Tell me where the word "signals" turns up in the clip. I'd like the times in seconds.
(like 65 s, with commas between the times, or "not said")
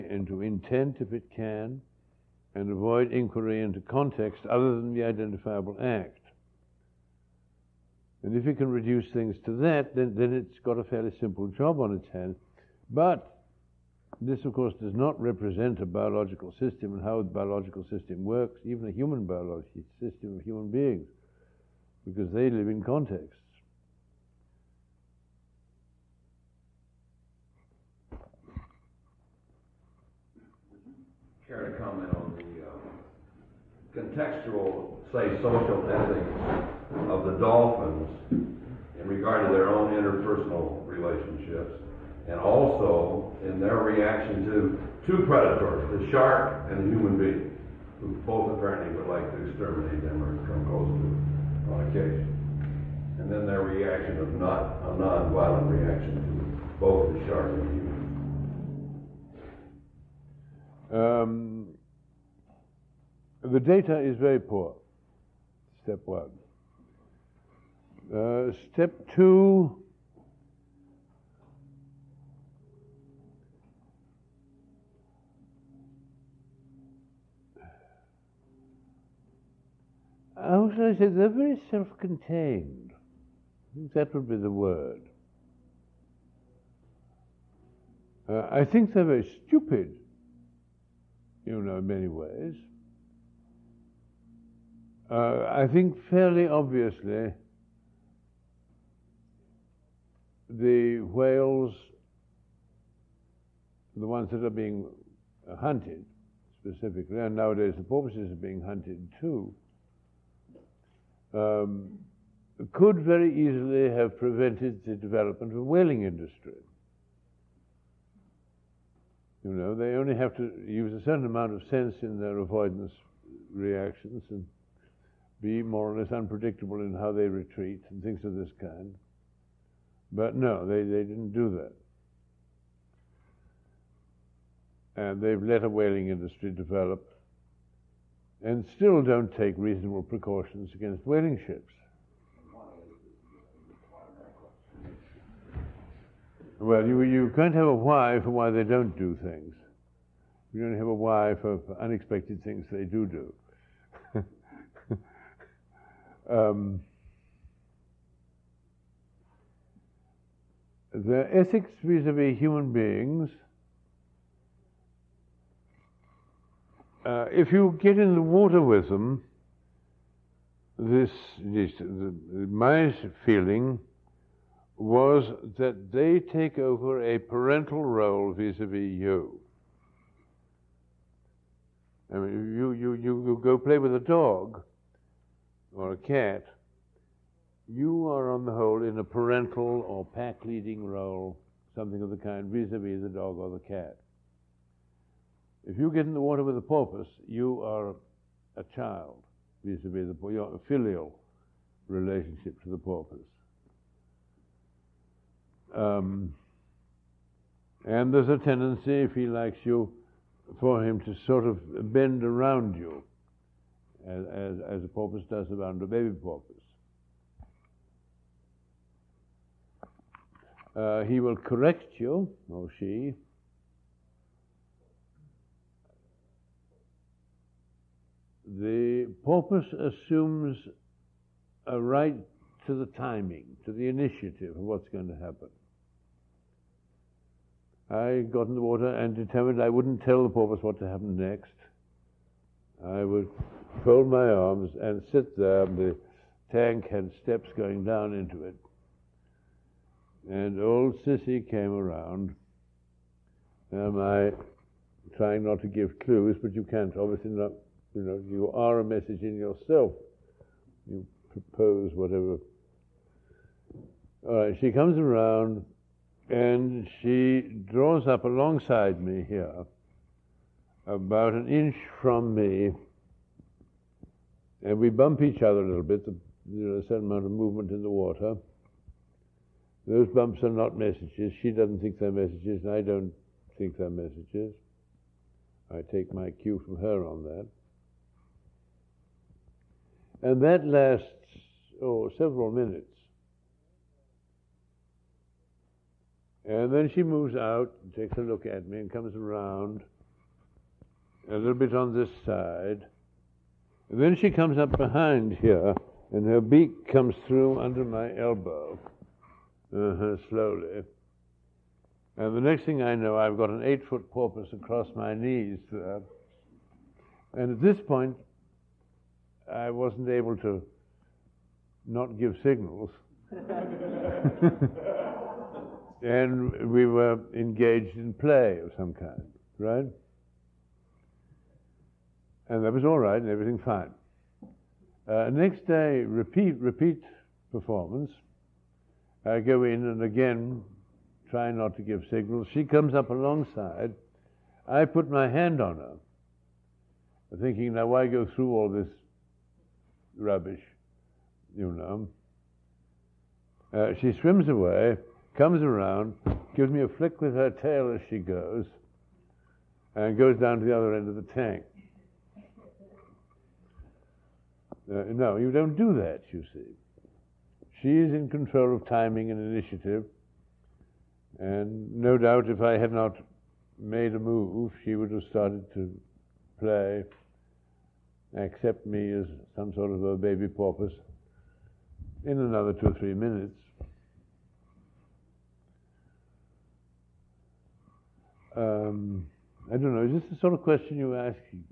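322 s, 342 s.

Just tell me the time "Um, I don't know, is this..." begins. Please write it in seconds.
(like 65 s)
388 s.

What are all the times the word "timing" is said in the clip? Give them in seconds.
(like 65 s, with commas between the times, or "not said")
232 s, 368 s.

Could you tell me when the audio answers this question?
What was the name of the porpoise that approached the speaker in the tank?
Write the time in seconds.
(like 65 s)
251 s.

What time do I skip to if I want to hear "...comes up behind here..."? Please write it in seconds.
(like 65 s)
304 s.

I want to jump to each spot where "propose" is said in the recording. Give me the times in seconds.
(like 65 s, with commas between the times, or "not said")
261 s.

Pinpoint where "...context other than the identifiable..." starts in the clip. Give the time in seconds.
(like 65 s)
3 s.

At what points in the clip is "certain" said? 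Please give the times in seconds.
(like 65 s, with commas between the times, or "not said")
121 s, 276 s.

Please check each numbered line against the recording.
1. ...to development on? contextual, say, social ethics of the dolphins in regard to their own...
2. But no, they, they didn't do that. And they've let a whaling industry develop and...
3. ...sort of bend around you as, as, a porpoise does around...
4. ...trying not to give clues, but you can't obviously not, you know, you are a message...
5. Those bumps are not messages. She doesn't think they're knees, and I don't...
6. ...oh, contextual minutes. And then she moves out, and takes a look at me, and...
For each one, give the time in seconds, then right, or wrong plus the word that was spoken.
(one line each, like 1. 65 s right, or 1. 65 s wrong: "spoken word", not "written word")
1. 31 s wrong: "comment", not "development"
2. 130 s right
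3. 211 s right
4. 255 s right
5. 279 s wrong: "messages", not "knees"
6. 291 s wrong: "several", not "contextual".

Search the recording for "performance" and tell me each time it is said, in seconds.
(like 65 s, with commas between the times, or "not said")
337 s.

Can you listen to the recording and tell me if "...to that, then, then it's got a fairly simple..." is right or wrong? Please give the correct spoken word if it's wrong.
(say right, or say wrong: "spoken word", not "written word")
right.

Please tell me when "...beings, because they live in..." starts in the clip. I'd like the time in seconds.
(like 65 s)
20 s.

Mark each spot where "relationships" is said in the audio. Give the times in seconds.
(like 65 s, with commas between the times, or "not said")
40 s, 201 s.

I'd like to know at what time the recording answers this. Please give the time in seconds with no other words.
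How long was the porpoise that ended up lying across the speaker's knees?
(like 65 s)
313 s.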